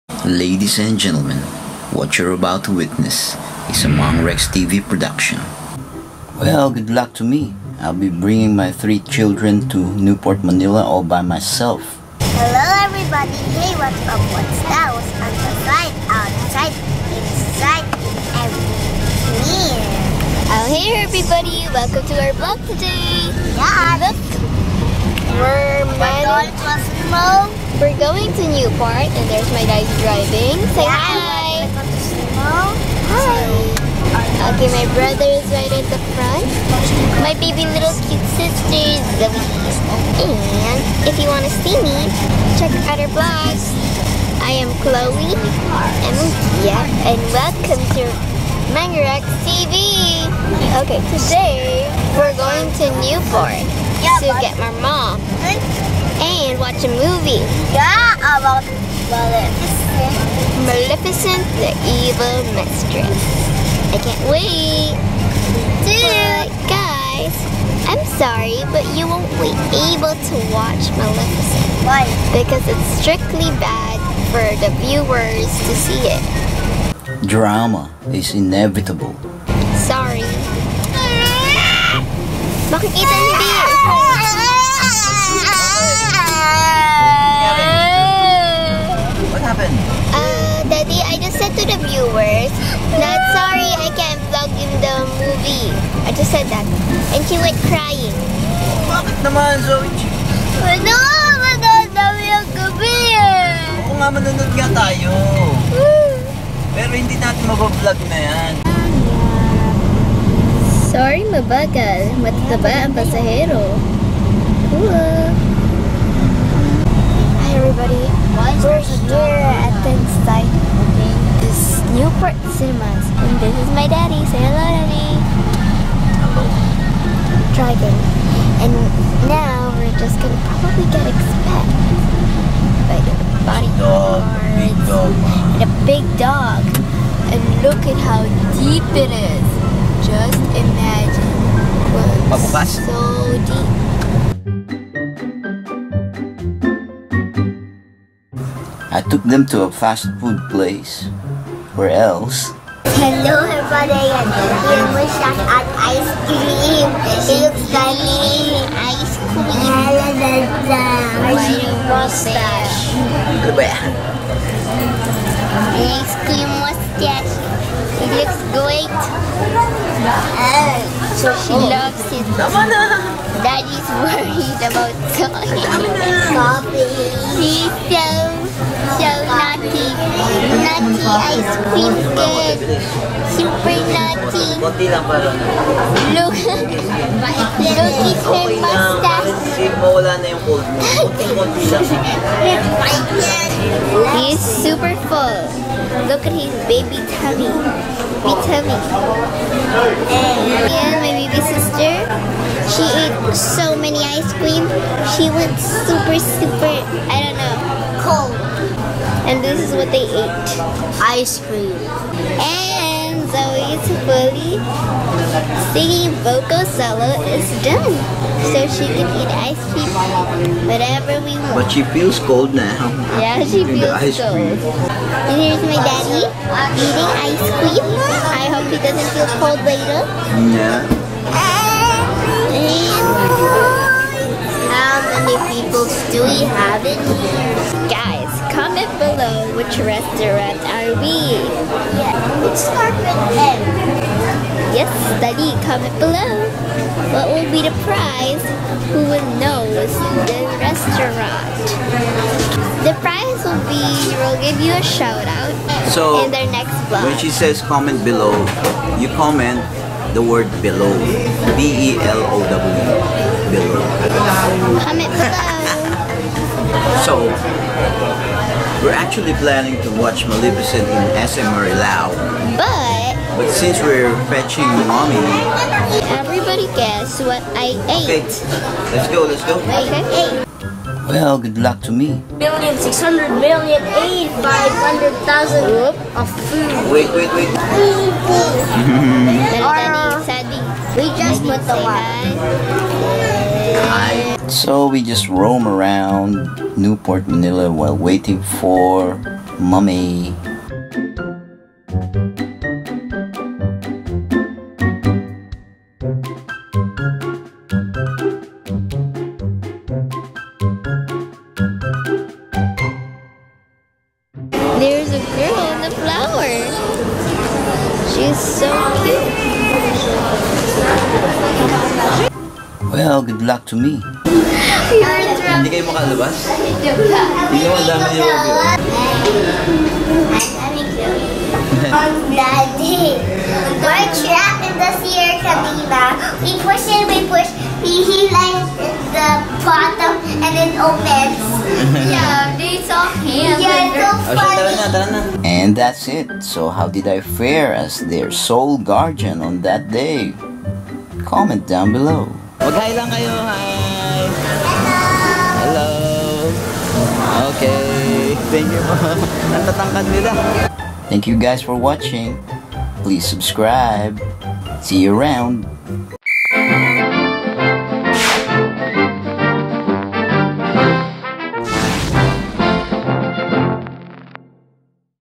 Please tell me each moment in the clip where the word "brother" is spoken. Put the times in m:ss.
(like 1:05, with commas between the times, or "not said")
0:34.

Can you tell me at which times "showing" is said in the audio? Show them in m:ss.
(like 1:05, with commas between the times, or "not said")
not said.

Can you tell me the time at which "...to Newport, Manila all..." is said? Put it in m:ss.
0:09.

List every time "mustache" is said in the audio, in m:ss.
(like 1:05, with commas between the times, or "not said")
2:41, 2:46, 3:08.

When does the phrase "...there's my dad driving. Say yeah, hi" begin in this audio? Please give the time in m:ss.
0:29.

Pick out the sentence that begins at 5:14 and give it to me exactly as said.
There's a girl in the flower.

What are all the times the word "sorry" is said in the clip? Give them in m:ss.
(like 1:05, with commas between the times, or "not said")
1:08, 1:19, 1:50.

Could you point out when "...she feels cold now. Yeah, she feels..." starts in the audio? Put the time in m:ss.
3:41.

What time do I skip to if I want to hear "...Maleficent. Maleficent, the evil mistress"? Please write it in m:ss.
0:59.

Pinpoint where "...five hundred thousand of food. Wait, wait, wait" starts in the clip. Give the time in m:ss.
4:44.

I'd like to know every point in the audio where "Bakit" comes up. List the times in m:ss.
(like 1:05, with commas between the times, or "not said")
1:22, 1:38.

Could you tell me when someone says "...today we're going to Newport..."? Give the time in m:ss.
0:51.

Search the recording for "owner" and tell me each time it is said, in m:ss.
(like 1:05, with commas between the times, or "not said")
not said.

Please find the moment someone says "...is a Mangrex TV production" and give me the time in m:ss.
0:03.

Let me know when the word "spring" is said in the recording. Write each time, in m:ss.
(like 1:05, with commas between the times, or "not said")
not said.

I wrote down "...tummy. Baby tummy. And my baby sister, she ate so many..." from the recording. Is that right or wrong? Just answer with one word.
right.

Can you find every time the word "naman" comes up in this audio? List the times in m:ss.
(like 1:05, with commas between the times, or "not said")
1:39, 5:27.